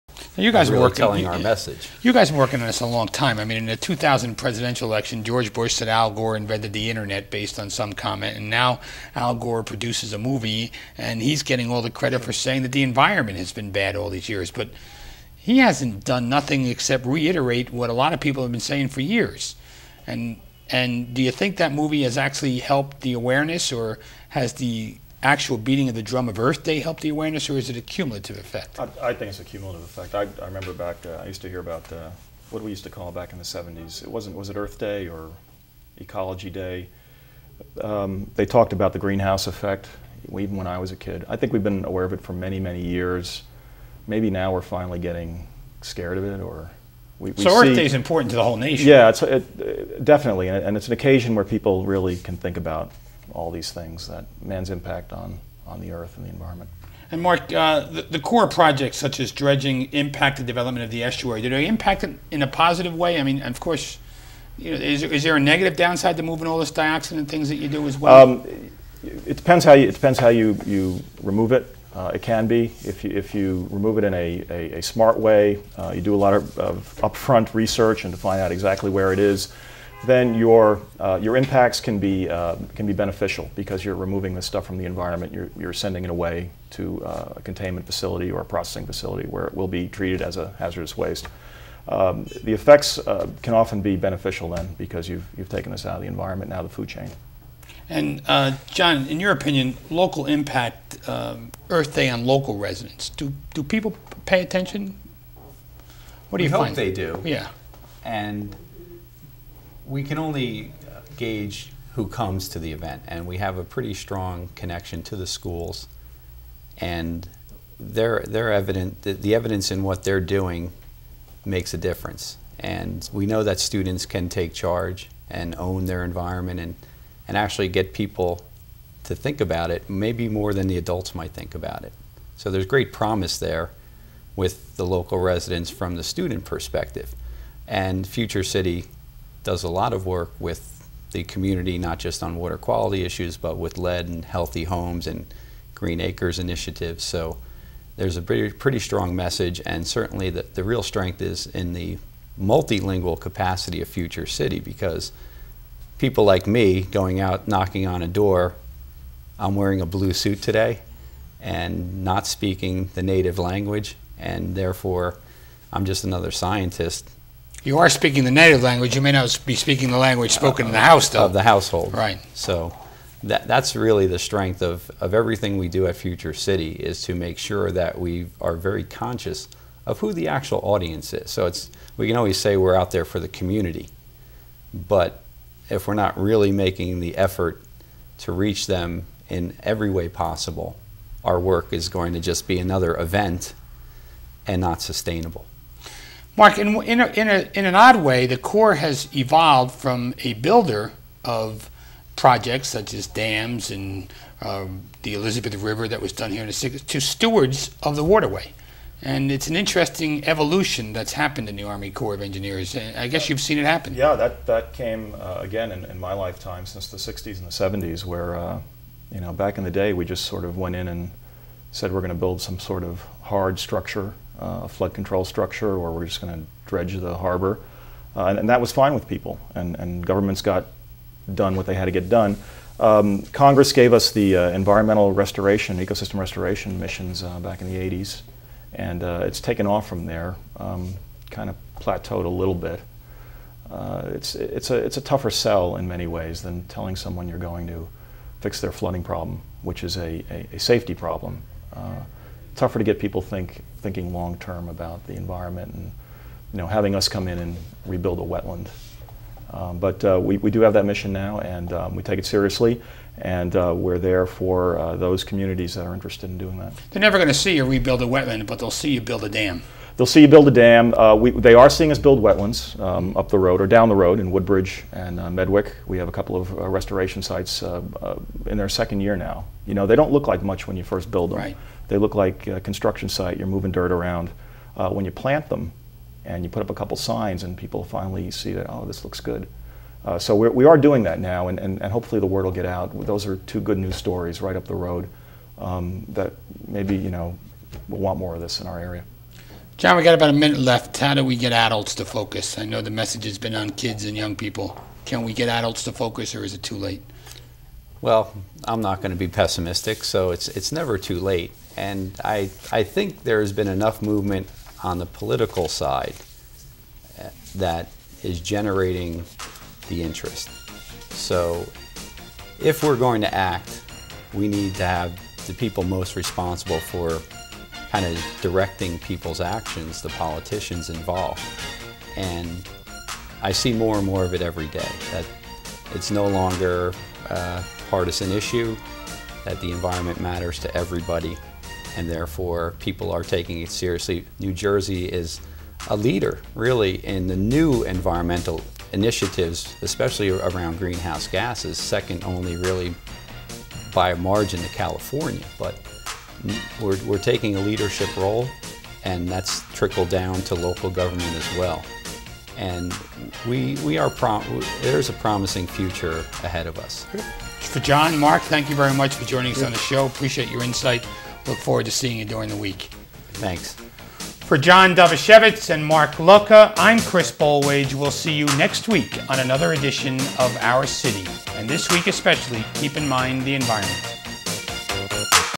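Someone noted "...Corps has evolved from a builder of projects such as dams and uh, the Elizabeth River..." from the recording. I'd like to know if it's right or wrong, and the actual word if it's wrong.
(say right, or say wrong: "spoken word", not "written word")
right.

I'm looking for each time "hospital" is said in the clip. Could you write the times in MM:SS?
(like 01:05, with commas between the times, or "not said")
not said.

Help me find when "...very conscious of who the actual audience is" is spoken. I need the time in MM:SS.
02:58.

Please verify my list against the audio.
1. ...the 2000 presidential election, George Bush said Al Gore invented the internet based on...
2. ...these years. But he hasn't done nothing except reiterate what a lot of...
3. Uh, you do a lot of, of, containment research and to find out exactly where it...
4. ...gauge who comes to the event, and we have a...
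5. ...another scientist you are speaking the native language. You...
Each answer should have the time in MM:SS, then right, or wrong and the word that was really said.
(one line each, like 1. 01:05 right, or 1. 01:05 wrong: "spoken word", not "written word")
1. 00:03 right
2. 00:14 right
3. 01:15 wrong: "upfront", not "containment"
4. 01:51 right
5. 02:46 right.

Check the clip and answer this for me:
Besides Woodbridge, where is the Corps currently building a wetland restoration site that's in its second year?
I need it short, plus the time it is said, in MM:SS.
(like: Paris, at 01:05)
Medwick, at 04:35.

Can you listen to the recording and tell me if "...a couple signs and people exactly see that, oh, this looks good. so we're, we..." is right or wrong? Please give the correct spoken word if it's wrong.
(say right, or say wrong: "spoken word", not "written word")
wrong: "finally", not "exactly".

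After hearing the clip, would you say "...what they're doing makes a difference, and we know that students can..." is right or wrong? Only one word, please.
right.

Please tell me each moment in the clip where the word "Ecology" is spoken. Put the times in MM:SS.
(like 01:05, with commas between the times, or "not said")
00:35.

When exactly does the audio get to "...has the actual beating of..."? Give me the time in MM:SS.
00:24.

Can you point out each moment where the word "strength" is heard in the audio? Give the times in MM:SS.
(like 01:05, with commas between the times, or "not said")
02:30, 02:54.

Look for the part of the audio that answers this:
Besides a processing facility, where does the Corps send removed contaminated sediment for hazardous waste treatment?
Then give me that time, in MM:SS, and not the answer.
01:27.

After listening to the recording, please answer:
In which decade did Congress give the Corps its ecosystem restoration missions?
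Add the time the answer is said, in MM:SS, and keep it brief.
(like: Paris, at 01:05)
The 80s, at 03:57.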